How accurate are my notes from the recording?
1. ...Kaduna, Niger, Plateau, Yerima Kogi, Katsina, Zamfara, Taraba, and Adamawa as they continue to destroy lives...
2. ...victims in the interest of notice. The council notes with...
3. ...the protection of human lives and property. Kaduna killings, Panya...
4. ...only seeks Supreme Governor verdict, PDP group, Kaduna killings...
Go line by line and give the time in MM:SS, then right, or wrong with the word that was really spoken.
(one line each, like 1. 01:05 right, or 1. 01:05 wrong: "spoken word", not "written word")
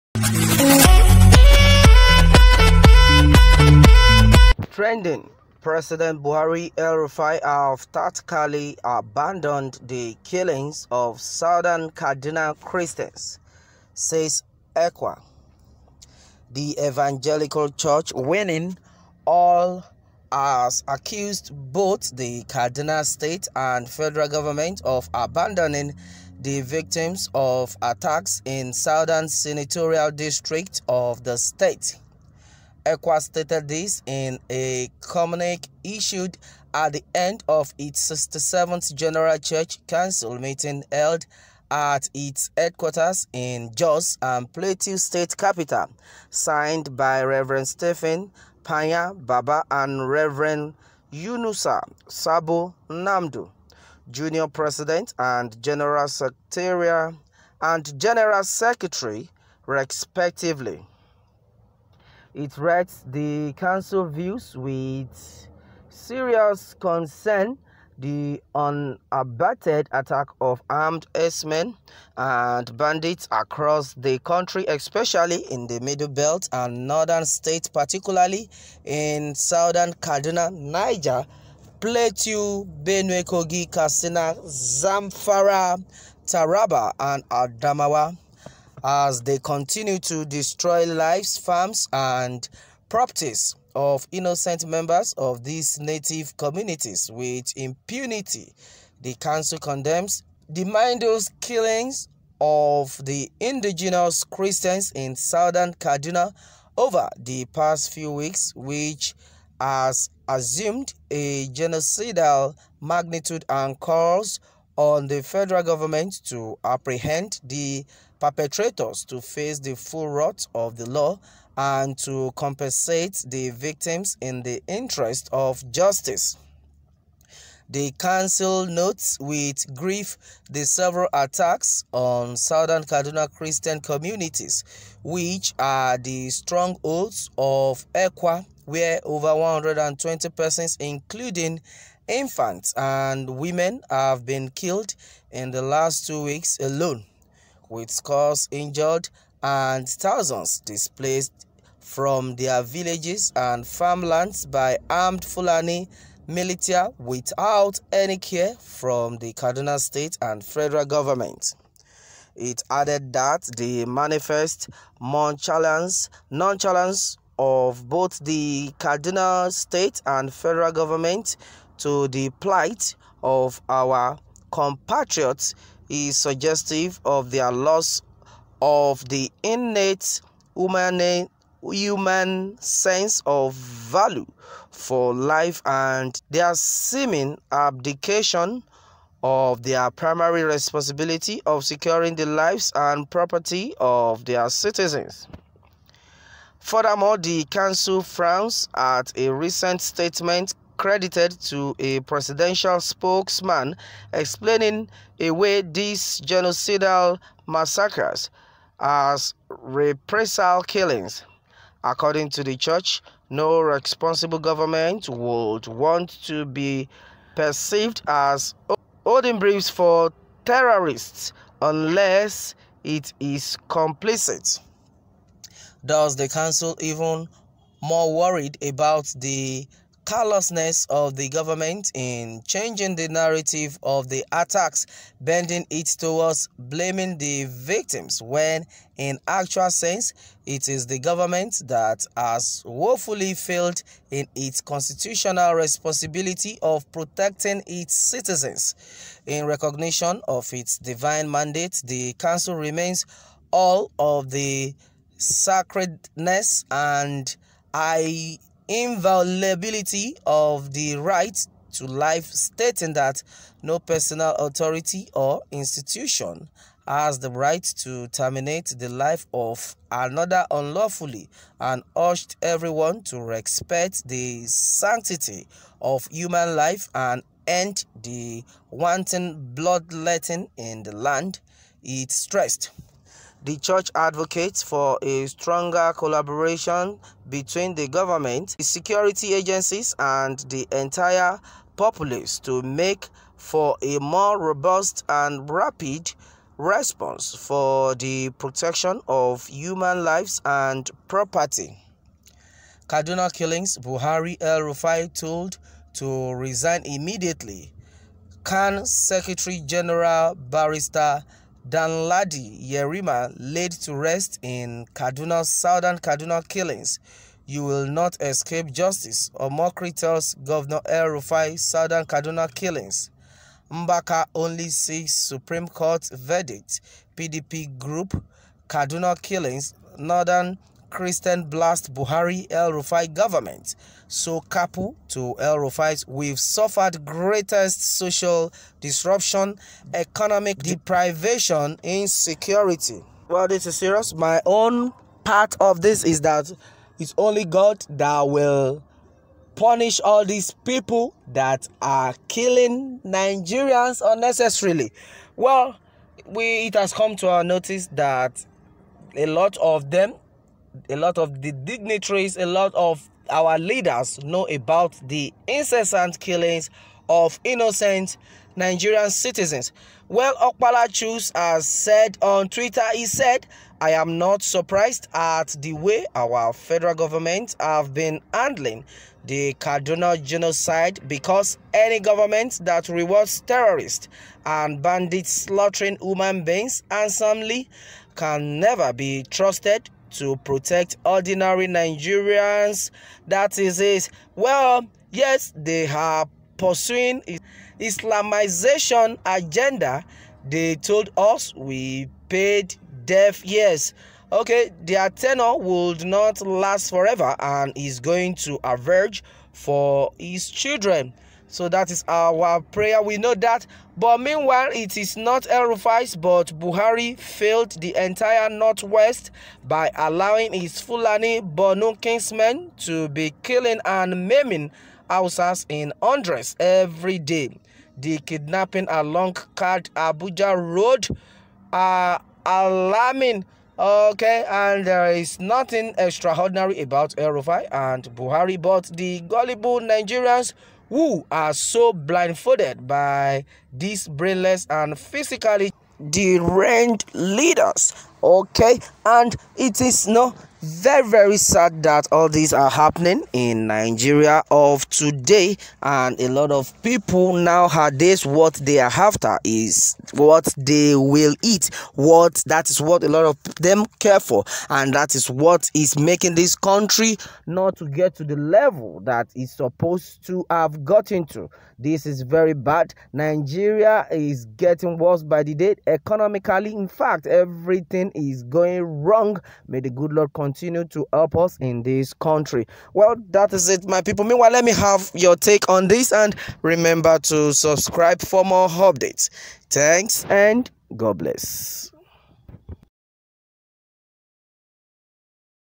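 1. 01:19 wrong: "Benue", not "Yerima"
2. 02:03 wrong: "justice", not "notice"
3. 04:57 wrong: "Buhari", not "Panya"
4. 05:24 wrong: "Court", not "Governor".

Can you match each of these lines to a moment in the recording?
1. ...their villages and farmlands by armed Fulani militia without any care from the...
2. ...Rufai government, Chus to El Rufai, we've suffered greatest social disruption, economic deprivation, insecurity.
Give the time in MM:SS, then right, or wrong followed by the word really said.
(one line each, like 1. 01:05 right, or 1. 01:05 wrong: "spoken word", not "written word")
1. 02:32 right
2. 05:32 wrong: "SOKAPU", not "Chus".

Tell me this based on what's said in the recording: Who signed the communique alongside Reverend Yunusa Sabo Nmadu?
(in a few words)
Reverend Stephen Panya Baba.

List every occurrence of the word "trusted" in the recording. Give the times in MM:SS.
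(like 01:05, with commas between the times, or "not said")
06:29.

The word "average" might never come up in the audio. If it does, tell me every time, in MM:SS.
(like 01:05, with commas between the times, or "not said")
06:48.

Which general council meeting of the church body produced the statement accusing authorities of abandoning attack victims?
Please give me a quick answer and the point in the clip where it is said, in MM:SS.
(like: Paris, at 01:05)
67th, at 00:38.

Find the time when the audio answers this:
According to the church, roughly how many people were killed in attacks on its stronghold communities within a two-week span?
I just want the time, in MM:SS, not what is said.
02:19.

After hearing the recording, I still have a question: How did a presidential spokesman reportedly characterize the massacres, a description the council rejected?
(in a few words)
reprisal killings.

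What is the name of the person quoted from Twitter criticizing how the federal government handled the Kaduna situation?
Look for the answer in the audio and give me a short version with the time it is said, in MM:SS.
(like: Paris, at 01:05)
Okpala Chus, at 06:10.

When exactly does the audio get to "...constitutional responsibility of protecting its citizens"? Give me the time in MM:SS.
04:04.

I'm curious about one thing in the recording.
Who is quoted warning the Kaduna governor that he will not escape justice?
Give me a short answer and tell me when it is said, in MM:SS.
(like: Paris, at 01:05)
Omokri, at 05:19.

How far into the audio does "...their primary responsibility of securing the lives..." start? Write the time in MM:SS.
03:09.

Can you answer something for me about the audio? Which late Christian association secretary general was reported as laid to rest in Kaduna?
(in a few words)
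Danladi Yerima.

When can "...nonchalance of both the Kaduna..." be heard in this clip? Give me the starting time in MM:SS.
02:46.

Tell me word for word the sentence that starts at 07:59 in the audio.
May the good Lord continue to help us in this country.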